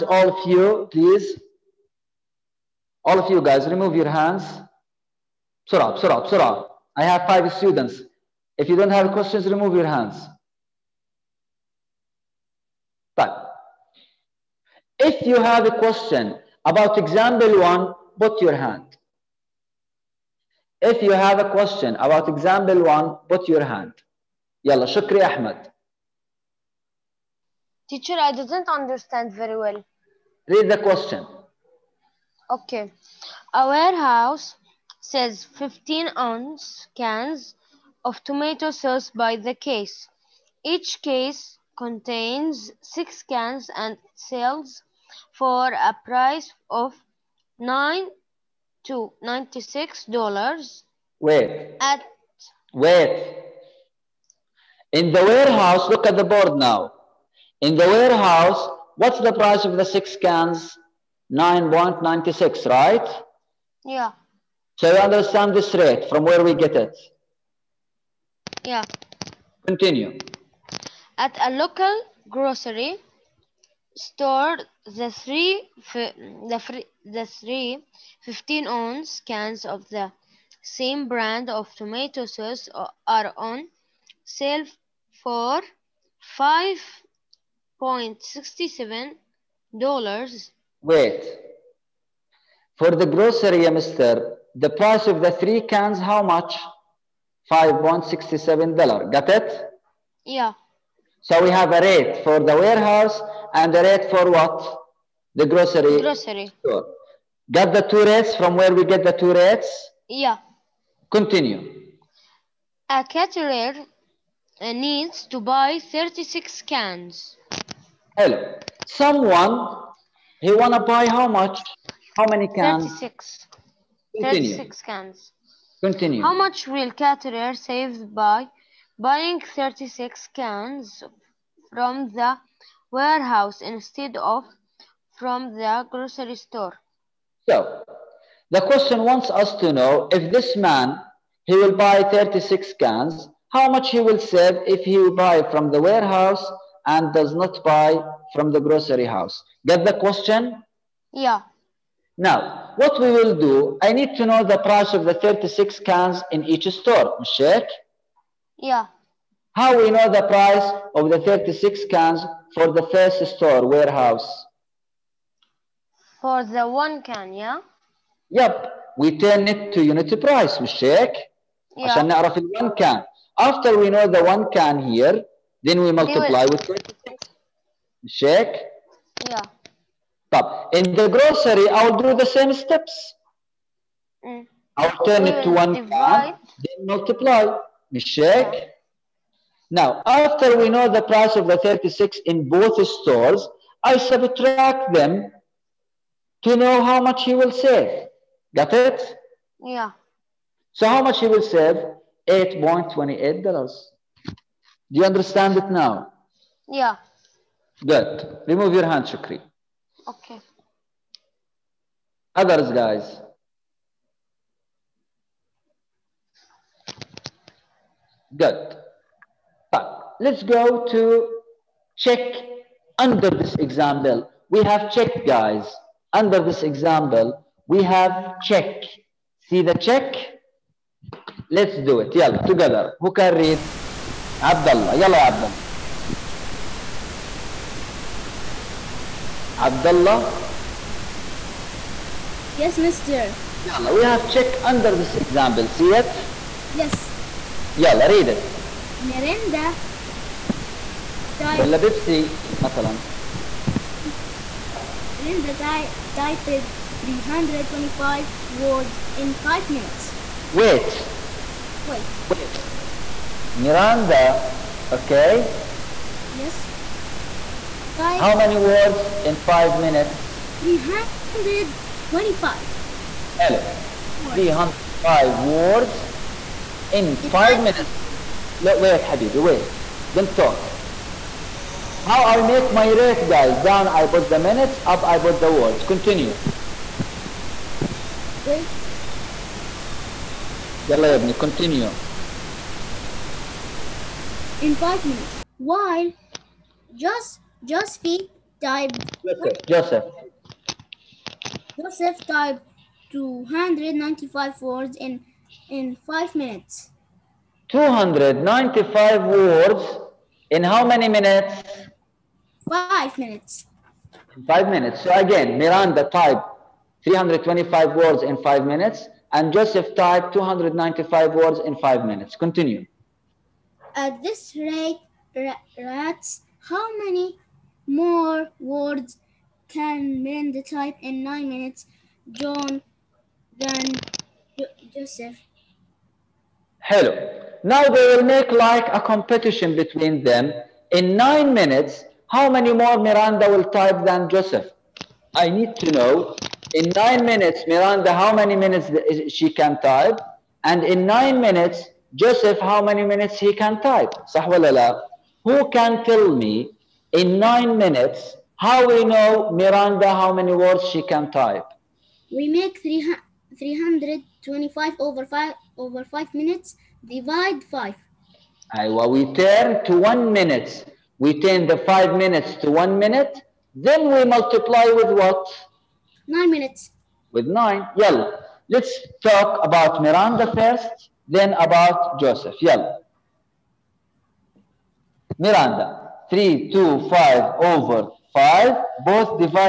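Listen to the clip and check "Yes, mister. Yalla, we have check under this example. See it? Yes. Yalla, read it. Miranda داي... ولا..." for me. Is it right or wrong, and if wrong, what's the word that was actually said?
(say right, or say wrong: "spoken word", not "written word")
right.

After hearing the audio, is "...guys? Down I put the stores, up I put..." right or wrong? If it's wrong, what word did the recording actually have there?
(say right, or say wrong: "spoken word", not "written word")
wrong: "minutes", not "stores".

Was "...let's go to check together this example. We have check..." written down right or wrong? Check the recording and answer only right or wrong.
wrong.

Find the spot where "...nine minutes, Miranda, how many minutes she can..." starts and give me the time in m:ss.
5:46.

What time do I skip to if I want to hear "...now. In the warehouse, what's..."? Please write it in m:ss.
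0:56.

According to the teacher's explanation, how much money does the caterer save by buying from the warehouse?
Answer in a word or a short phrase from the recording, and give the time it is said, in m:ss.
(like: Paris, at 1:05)
$8.28, at 3:22.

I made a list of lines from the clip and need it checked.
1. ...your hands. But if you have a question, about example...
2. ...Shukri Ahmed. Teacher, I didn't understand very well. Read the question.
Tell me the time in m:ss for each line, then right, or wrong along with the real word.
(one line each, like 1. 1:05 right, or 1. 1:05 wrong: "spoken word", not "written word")
1. 0:09 right
2. 0:24 right.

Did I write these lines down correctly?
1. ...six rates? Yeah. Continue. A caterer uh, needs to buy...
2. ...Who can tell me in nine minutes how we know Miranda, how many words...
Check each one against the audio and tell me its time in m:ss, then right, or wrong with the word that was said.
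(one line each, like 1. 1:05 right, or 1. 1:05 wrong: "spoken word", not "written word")
1. 1:49 wrong: "two", not "six"
2. 5:55 right.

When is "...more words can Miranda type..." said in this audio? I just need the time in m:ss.
5:27.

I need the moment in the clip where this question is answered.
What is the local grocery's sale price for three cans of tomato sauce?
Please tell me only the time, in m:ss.
1:26.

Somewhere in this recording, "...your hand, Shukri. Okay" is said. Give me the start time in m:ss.
3:28.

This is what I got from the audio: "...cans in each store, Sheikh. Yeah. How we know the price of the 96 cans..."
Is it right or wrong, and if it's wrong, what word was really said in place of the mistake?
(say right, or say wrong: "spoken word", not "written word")
wrong: "36", not "96".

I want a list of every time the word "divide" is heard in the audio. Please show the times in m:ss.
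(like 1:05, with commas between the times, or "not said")
3:05, 6:07.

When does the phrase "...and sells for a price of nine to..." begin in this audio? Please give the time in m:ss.
0:43.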